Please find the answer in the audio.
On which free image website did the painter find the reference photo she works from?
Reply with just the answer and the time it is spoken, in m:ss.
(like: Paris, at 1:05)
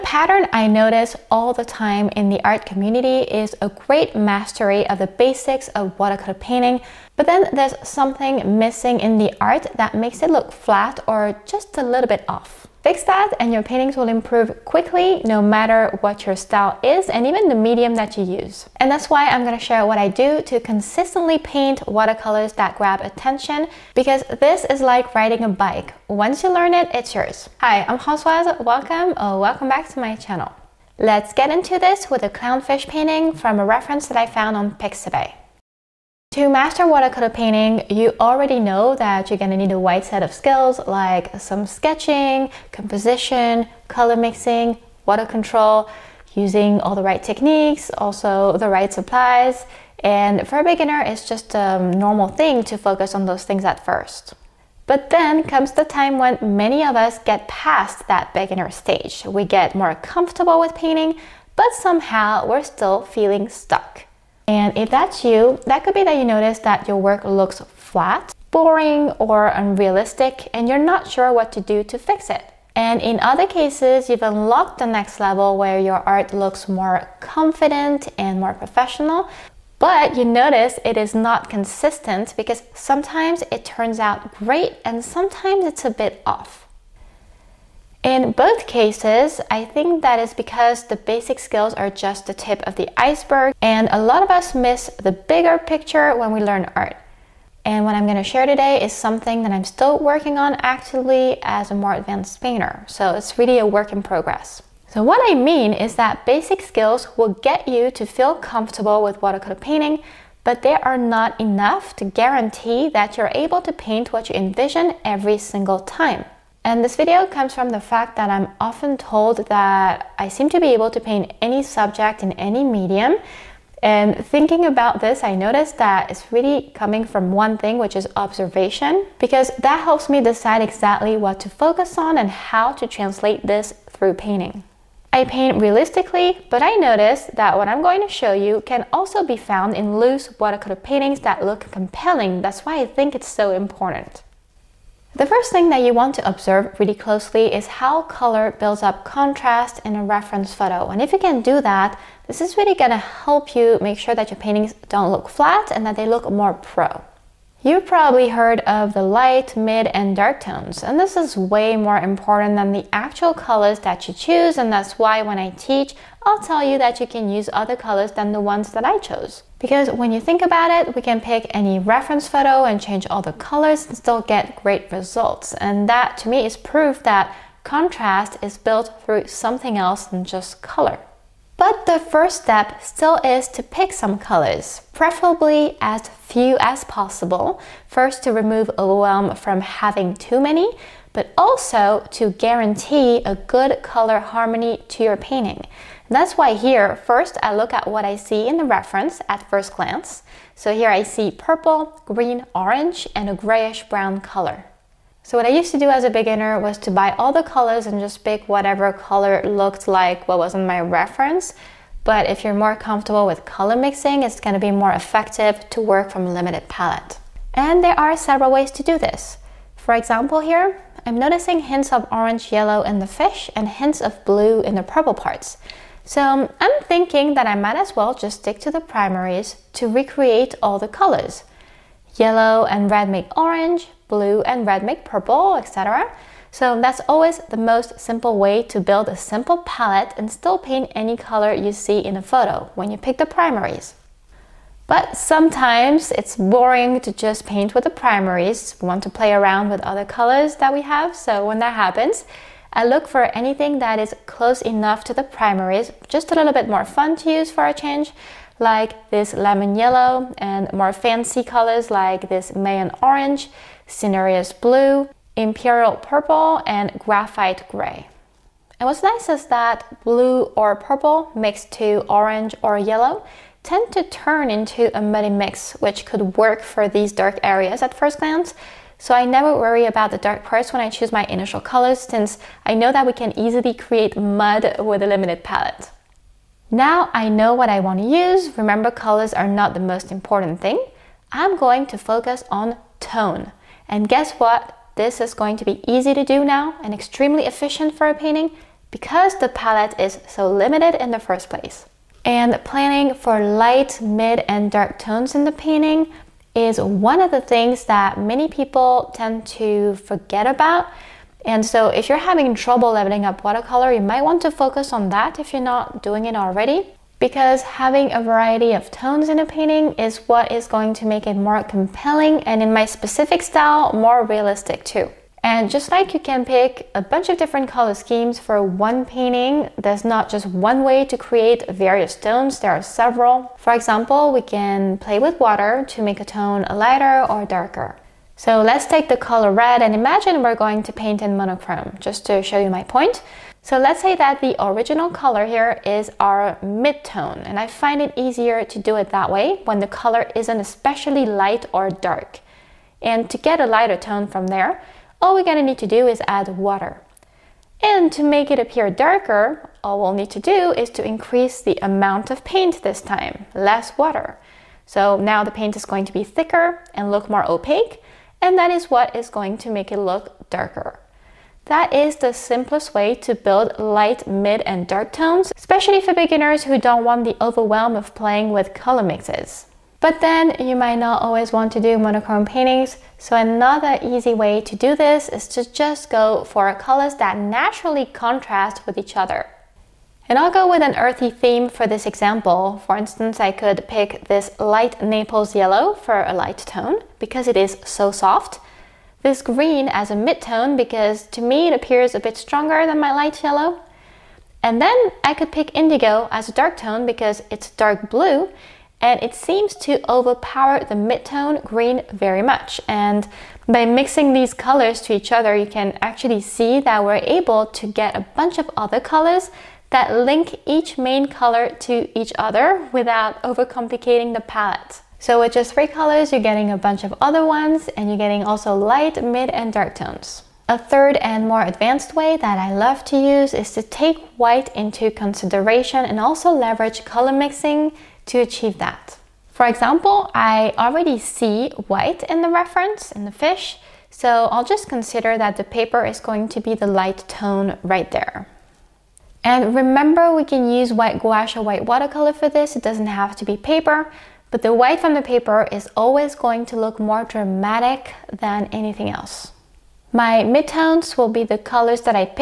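Pixabay, at 0:34.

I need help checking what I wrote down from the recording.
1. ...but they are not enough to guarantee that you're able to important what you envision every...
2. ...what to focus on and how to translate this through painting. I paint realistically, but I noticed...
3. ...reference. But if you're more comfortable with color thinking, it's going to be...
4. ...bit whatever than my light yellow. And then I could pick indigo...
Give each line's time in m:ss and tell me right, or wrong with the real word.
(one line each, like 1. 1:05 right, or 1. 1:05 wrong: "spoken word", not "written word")
1. 1:50 wrong: "paint", not "important"
2. 2:11 right
3. 3:30 wrong: "mixing", not "thinking"
4. 6:42 wrong: "stronger", not "whatever".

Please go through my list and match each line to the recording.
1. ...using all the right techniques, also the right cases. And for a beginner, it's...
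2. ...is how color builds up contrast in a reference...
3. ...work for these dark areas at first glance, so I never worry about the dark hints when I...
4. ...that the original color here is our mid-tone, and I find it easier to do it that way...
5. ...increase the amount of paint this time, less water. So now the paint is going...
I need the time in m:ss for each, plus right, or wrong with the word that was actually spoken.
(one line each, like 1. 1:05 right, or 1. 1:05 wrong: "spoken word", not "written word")
1. 0:46 wrong: "supplies", not "cases"
2. 2:27 right
3. 4:36 wrong: "parts", not "hints"
4. 5:44 right
5. 6:01 right.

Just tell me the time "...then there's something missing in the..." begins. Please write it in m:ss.
0:07.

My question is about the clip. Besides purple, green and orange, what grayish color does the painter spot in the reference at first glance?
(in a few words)
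Grayish brown.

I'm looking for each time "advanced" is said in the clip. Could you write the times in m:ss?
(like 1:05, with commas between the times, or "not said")
1:41, 7:11.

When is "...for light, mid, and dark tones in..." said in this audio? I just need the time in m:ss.
5:03.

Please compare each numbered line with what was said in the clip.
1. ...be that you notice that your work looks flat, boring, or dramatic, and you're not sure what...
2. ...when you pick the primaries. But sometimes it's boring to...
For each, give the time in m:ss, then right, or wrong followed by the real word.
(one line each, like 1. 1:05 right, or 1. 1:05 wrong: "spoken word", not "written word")
1. 1:05 wrong: "unrealistic", not "dramatic"
2. 4:02 right.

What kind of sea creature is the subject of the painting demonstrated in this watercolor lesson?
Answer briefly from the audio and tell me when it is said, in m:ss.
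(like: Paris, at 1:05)
Clownfish, at 0:32.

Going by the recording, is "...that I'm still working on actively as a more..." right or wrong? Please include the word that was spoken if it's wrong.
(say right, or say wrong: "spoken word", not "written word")
right.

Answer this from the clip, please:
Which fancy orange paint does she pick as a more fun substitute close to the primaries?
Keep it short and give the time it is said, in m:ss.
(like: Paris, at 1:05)
Mayan orange, at 4:22.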